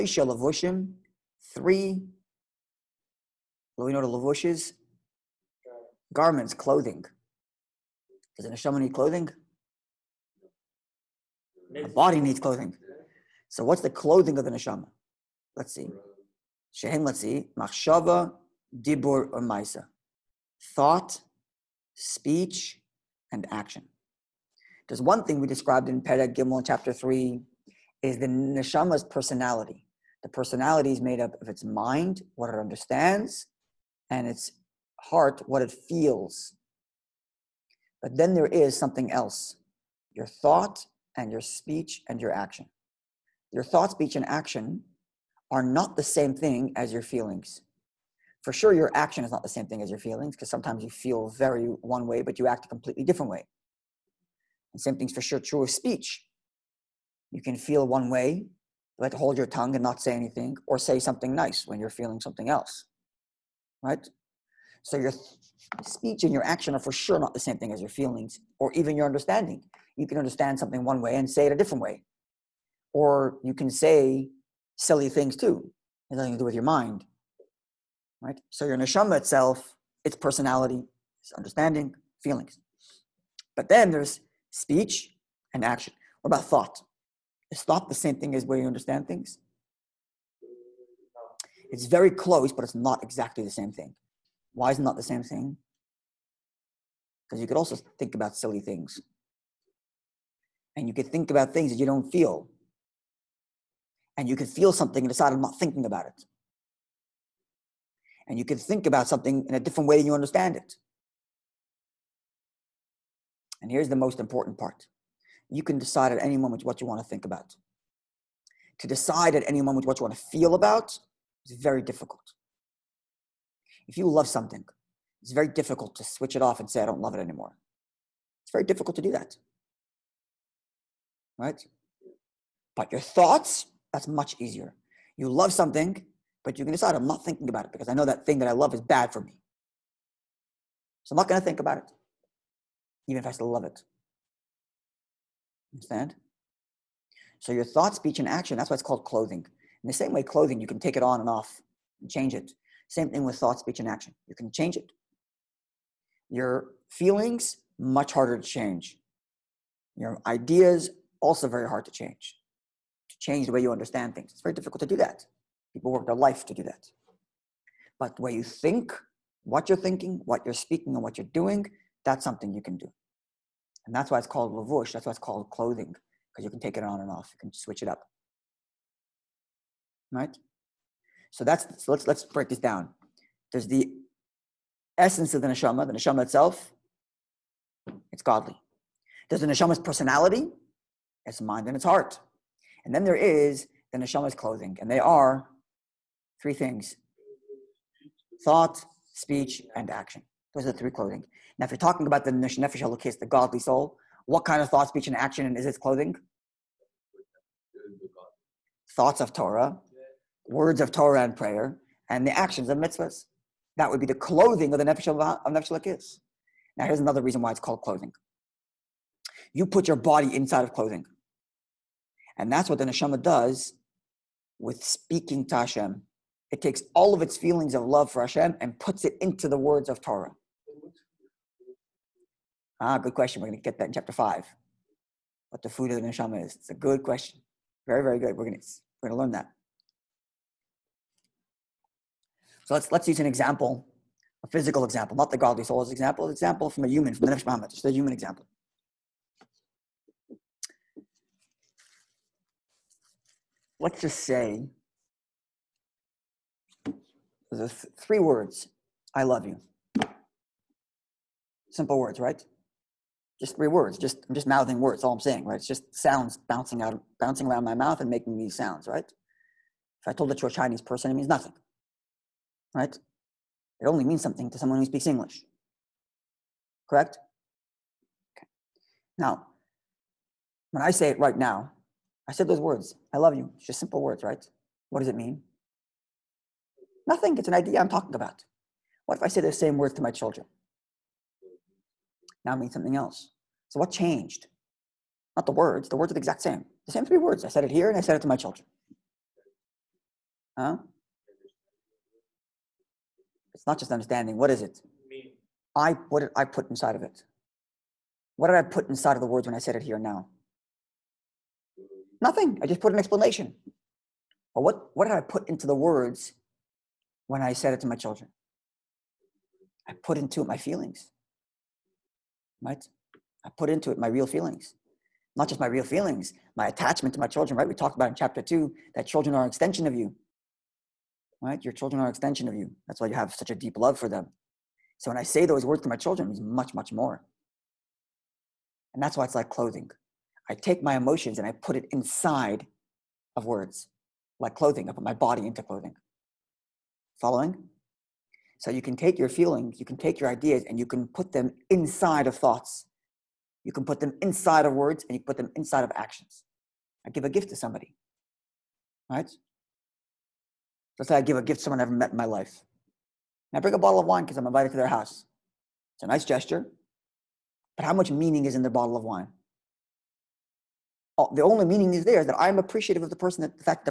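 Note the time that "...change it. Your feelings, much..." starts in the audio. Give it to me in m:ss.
2:34.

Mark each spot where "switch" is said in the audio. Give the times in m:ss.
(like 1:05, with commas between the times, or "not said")
2:06, 2:57.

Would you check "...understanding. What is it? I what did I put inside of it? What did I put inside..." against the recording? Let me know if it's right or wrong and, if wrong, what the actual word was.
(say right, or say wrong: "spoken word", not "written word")
right.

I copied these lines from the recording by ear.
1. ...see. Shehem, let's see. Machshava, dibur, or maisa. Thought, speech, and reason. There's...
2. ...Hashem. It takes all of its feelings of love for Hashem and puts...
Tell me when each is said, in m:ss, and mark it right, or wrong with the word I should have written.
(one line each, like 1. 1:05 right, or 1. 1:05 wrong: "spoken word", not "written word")
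1. 0:15 wrong: "action", not "reason"
2. 3:45 right.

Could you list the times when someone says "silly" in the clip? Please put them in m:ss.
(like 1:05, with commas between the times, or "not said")
1:14, 1:38.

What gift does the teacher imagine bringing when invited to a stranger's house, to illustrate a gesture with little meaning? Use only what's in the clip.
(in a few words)
a bottle of wine.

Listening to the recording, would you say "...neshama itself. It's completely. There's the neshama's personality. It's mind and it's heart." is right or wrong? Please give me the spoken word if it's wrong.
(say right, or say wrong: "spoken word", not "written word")
wrong: "godly", not "completely".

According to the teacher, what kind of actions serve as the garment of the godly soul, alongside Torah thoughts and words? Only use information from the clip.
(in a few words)
mitzvahs.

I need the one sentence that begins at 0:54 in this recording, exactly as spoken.
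And same thing's for sure true of speech.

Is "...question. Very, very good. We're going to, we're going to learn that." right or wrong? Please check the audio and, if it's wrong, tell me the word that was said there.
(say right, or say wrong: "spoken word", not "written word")
right.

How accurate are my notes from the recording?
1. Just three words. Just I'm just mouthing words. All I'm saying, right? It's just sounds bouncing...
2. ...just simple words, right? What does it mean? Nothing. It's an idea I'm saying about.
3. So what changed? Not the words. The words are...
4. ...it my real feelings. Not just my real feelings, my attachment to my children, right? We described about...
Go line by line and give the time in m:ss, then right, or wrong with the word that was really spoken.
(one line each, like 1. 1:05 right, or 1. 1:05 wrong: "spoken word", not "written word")
1. 4:23 right
2. 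4:43 wrong: "talking", not "saying"
3. 4:53 right
4. 5:23 wrong: "talked", not "described".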